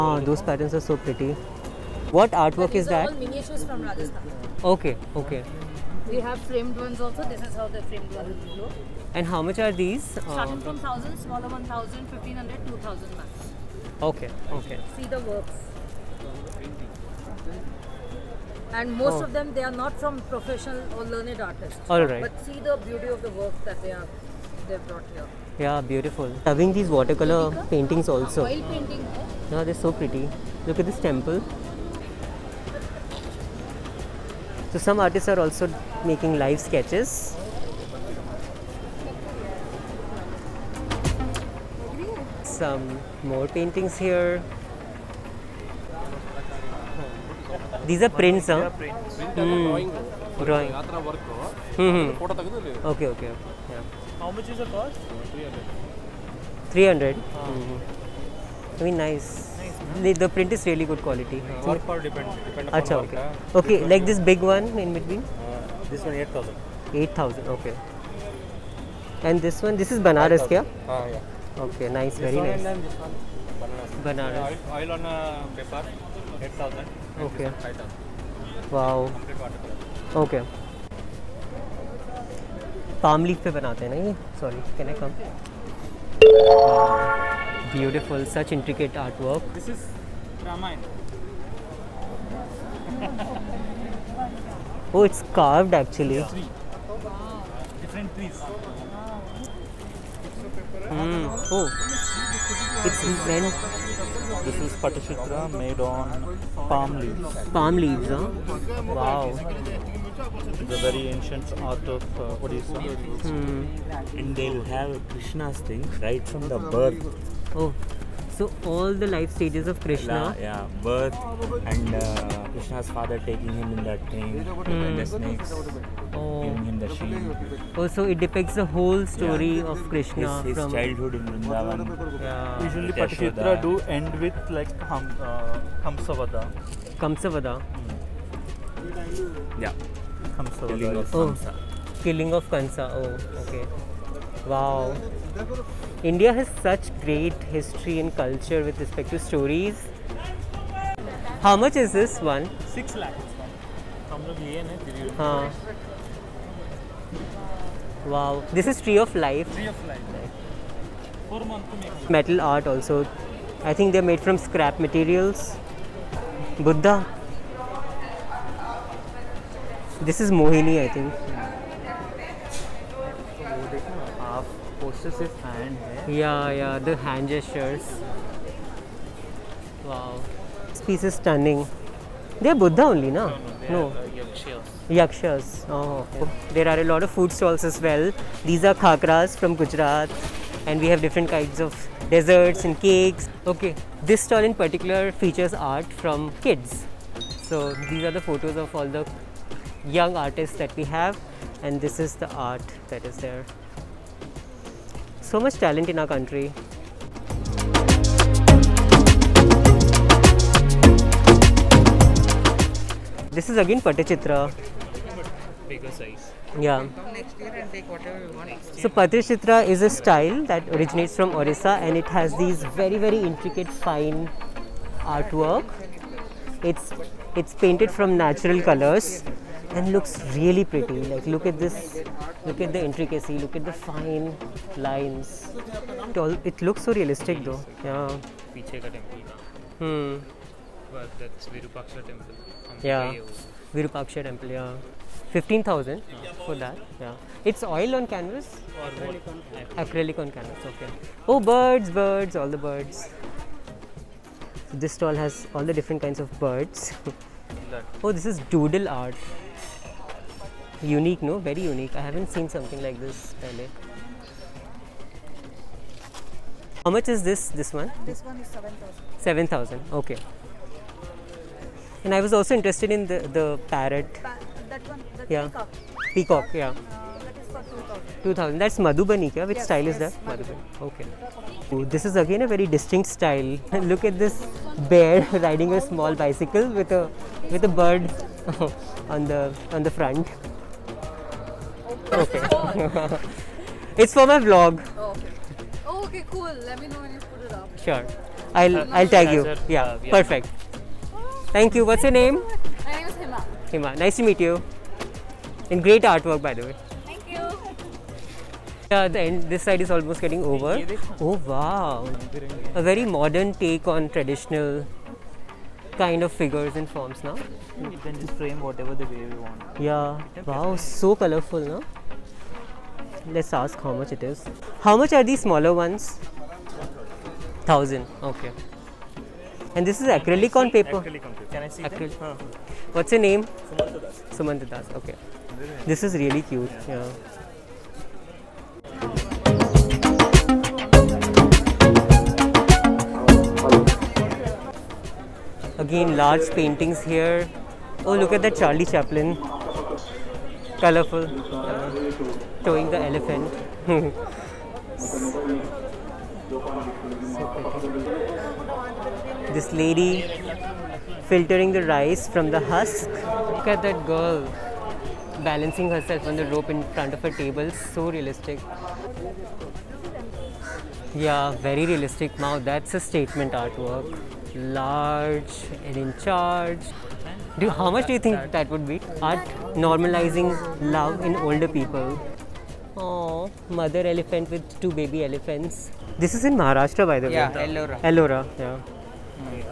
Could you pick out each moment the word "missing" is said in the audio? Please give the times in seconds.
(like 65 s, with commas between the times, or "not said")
not said.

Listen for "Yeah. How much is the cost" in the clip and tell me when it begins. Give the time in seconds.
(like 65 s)
53 s.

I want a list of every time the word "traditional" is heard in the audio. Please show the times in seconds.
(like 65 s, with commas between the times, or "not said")
314 s.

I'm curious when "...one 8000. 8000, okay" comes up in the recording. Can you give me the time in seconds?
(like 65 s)
66 s.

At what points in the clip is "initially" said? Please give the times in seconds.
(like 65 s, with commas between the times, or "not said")
not said.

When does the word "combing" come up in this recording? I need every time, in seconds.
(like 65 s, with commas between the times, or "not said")
not said.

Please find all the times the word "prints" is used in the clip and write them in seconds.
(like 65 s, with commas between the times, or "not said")
48 s, 60 s.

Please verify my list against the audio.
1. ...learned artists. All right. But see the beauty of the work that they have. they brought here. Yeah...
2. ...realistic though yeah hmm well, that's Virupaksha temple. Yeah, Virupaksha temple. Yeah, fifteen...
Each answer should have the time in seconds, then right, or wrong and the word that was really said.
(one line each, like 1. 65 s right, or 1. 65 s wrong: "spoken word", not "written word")
1. 21 s right
2. 236 s right.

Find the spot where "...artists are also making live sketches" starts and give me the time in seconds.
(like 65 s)
34 s.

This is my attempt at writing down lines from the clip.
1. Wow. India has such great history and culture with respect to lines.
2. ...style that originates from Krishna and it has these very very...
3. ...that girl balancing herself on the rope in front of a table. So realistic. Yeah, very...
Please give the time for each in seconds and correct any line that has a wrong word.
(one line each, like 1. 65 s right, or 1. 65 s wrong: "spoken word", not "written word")
1. 144 s wrong: "stories", not "lines"
2. 219 s wrong: "Orissa", not "Krishna"
3. 363 s right.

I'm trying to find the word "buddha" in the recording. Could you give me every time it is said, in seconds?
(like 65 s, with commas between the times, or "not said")
166 s, 182 s.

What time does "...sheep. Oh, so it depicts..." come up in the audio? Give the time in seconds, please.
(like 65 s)
126 s.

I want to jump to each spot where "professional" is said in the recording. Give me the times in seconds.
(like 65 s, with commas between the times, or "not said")
20 s.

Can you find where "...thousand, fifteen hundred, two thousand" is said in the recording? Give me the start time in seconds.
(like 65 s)
11 s.